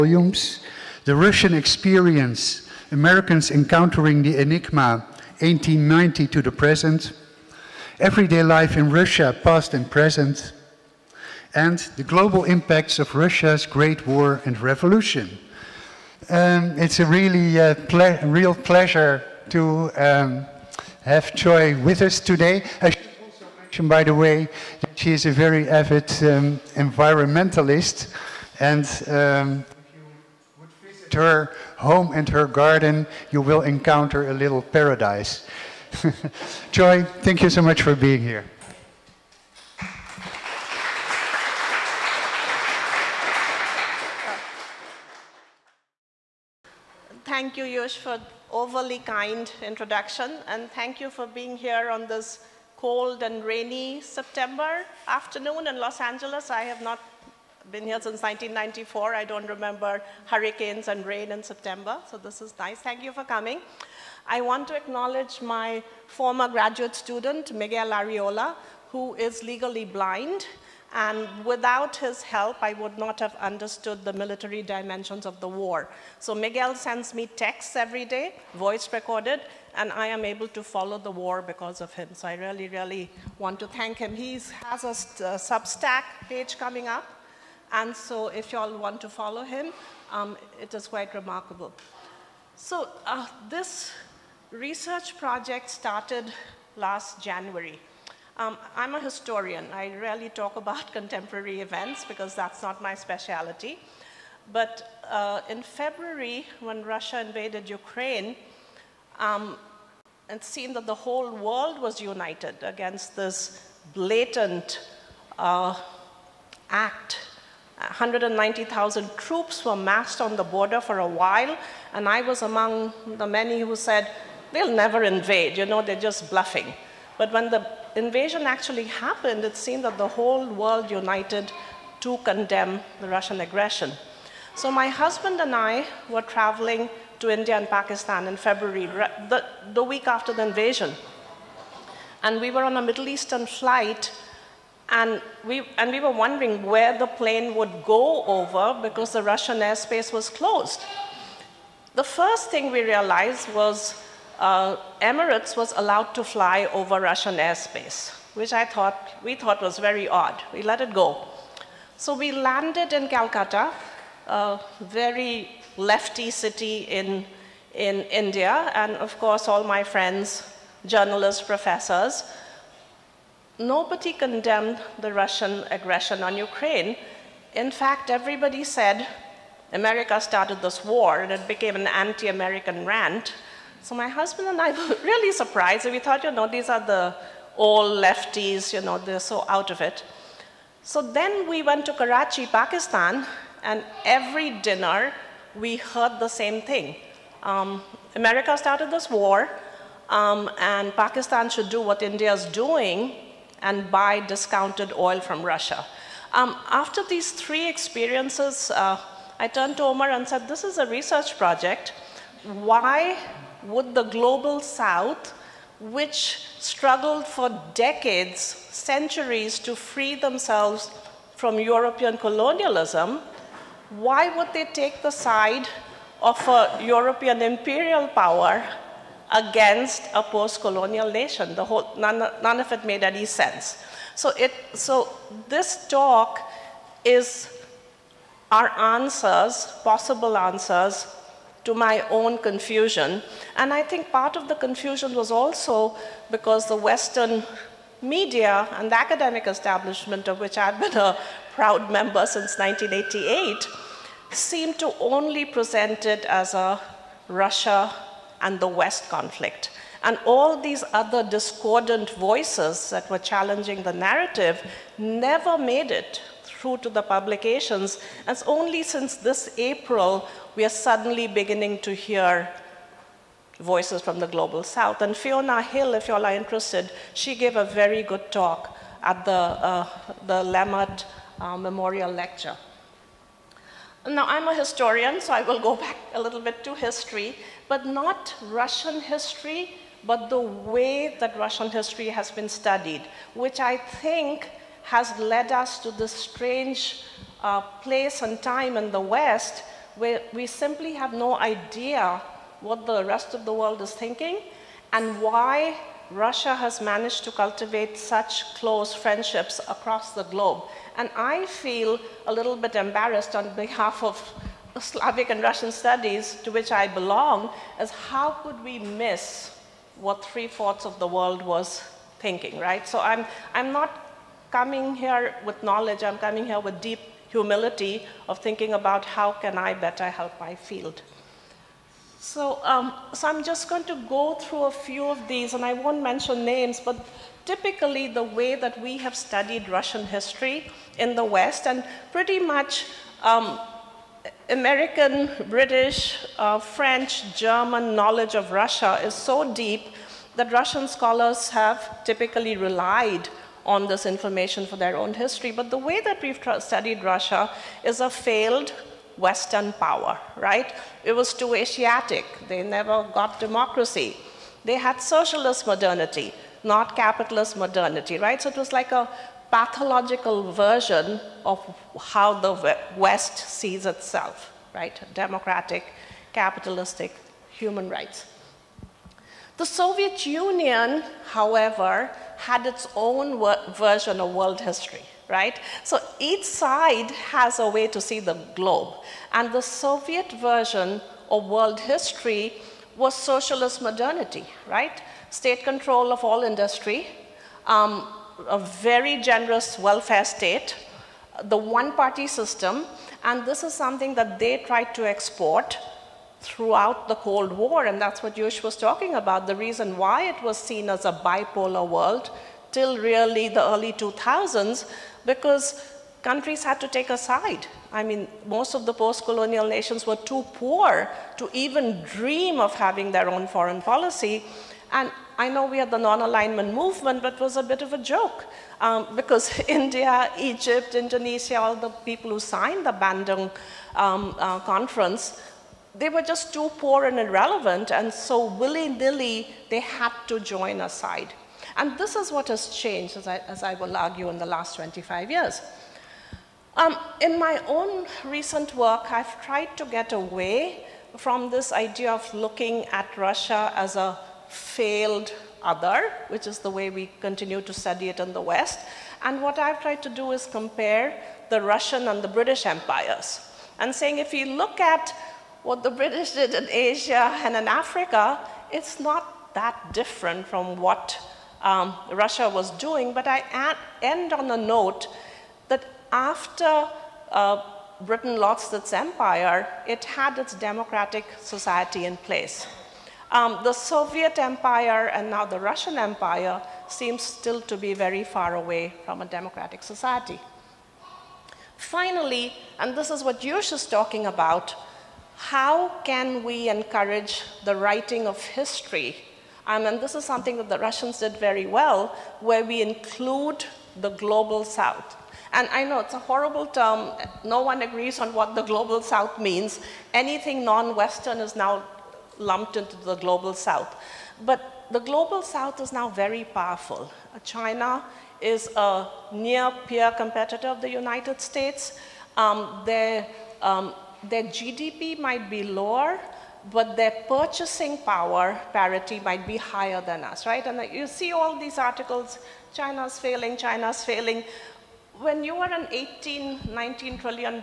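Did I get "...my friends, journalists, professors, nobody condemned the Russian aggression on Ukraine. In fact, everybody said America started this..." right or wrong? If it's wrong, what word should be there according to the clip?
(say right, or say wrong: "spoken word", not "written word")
right.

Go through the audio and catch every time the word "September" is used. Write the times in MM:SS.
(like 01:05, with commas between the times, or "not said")
00:54, 01:01.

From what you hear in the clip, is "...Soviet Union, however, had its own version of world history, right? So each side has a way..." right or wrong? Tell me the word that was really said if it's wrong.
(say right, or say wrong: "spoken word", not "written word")
right.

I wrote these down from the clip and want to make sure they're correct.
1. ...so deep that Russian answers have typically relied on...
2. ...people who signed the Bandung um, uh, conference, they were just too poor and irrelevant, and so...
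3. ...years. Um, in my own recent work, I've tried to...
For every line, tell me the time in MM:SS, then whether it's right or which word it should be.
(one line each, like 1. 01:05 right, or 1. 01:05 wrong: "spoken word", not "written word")
1. 05:49 wrong: "scholars", not "answers"
2. 07:11 right
3. 07:25 right.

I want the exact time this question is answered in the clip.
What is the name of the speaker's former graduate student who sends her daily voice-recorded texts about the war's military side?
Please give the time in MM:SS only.
01:07.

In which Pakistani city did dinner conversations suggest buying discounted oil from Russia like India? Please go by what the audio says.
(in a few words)
Karachi.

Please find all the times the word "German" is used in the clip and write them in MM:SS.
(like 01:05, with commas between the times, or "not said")
05:47.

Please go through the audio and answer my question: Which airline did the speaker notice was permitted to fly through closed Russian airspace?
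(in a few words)
Emirates.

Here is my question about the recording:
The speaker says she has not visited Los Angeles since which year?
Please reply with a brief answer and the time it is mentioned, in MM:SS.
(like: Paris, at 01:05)
1994, at 00:58.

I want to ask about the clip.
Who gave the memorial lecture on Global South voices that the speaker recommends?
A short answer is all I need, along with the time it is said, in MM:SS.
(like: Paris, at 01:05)
Fiona Hill, at 04:35.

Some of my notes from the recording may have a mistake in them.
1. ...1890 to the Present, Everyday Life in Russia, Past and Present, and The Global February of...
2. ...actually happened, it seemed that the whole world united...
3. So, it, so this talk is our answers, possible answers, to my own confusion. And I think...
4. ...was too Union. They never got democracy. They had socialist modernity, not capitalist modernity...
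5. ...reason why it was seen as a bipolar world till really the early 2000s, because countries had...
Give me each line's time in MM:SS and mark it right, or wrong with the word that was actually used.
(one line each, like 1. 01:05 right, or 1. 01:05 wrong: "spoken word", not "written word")
1. 00:05 wrong: "Impacts", not "February"
2. 02:08 right
3. 03:54 right
4. 06:01 wrong: "Asiatic", not "Union"
5. 06:49 right.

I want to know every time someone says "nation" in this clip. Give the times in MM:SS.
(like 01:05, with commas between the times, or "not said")
03:51, 06:59.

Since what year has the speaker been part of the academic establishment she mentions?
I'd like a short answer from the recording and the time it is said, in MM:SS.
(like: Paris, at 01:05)
1988, at 04:12.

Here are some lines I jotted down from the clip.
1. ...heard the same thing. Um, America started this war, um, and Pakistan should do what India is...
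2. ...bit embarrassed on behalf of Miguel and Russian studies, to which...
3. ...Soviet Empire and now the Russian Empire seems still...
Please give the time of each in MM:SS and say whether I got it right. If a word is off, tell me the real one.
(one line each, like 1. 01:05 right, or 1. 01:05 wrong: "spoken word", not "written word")
1. 03:15 right
2. 05:12 wrong: "Slavic", not "Miguel"
3. 08:03 right.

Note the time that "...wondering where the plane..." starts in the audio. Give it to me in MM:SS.
02:26.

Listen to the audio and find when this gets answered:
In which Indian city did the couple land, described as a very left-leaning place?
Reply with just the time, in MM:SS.
02:43.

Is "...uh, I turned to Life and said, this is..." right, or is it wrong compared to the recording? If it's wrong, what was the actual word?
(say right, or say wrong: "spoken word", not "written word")
wrong: "Omar", not "Life".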